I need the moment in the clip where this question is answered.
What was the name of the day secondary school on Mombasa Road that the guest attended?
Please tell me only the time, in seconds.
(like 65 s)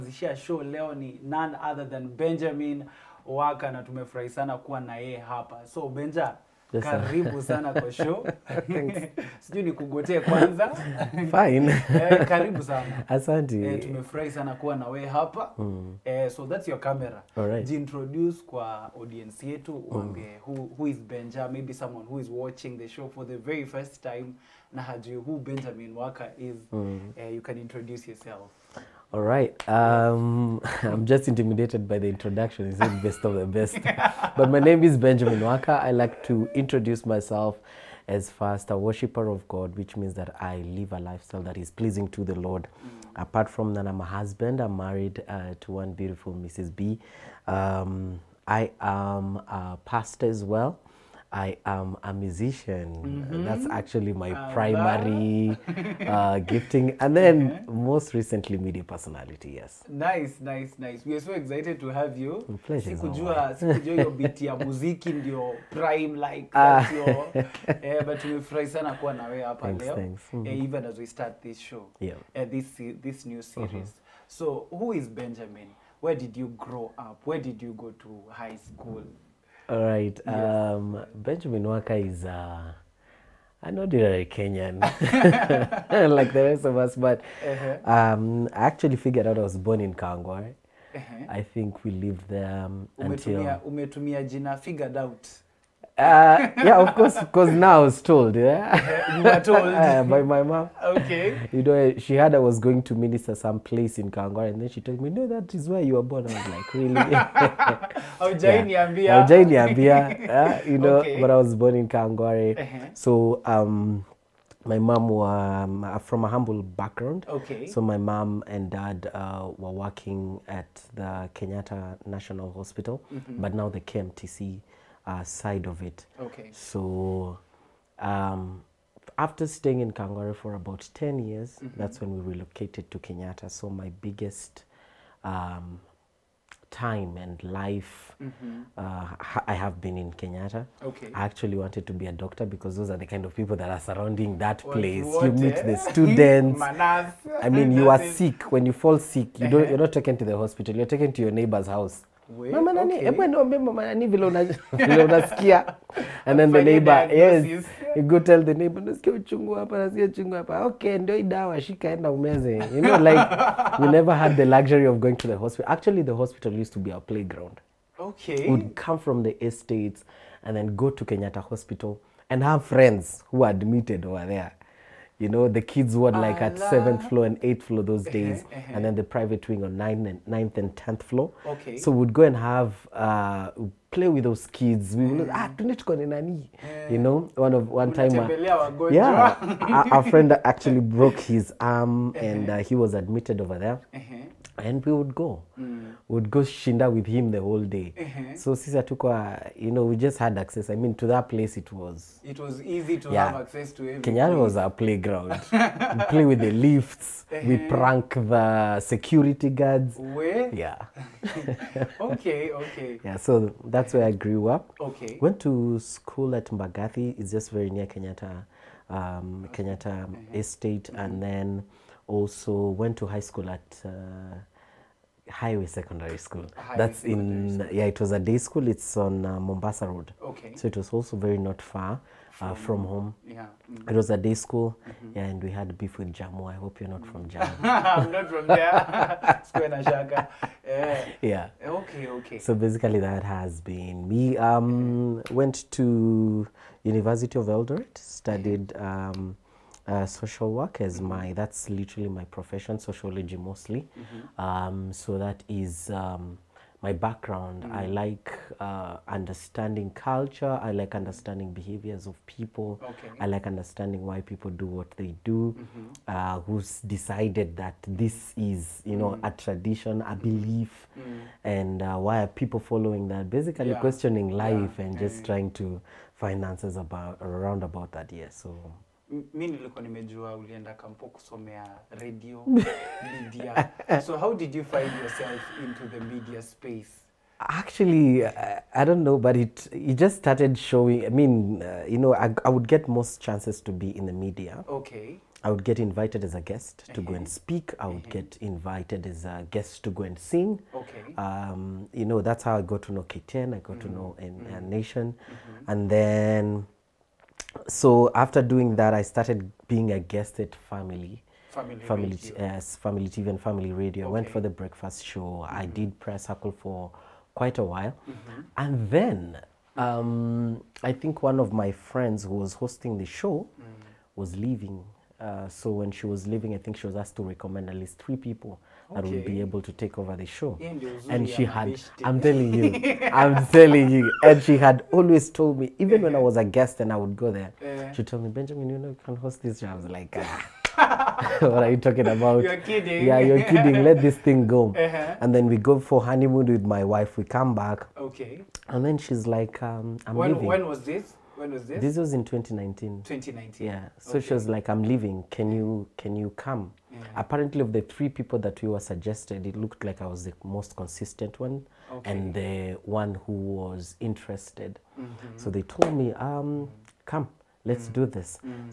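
225 s.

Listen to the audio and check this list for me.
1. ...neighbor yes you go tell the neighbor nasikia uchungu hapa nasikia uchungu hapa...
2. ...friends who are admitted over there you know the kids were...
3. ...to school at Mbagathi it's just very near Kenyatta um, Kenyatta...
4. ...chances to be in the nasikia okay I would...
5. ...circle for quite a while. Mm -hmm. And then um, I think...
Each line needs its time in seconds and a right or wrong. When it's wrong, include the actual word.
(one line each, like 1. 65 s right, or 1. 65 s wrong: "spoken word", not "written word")
1. 156 s right
2. 172 s right
3. 215 s right
4. 293 s wrong: "media", not "nasikia"
5. 316 s right.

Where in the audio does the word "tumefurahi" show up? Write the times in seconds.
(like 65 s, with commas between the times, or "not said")
3 s, 13 s, 68 s.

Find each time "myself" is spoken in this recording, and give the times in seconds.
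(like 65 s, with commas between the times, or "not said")
37 s.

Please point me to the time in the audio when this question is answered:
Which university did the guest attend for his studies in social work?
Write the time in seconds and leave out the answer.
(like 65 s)
246 s.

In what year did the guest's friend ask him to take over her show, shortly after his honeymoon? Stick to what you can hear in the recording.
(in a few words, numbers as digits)
2019.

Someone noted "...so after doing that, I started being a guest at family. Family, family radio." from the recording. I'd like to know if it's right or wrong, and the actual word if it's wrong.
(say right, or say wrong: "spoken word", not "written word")
right.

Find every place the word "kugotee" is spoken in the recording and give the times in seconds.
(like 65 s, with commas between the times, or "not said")
9 s.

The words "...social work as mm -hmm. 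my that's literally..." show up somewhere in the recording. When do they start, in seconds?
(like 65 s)
250 s.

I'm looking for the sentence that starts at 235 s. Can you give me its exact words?
yeah, and we had beef with Jamu.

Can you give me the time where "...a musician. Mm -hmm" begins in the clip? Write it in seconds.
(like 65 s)
52 s.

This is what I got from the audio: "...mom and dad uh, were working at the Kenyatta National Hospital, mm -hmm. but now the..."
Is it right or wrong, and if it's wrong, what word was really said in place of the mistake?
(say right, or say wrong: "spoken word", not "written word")
right.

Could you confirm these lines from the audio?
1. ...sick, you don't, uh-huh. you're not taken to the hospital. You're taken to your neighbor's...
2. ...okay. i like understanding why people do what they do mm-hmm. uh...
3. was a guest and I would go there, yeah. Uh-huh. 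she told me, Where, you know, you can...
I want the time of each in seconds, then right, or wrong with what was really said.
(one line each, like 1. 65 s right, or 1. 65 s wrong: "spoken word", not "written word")
1. 148 s right
2. 262 s right
3. 336 s wrong: "Benjamin", not "Where".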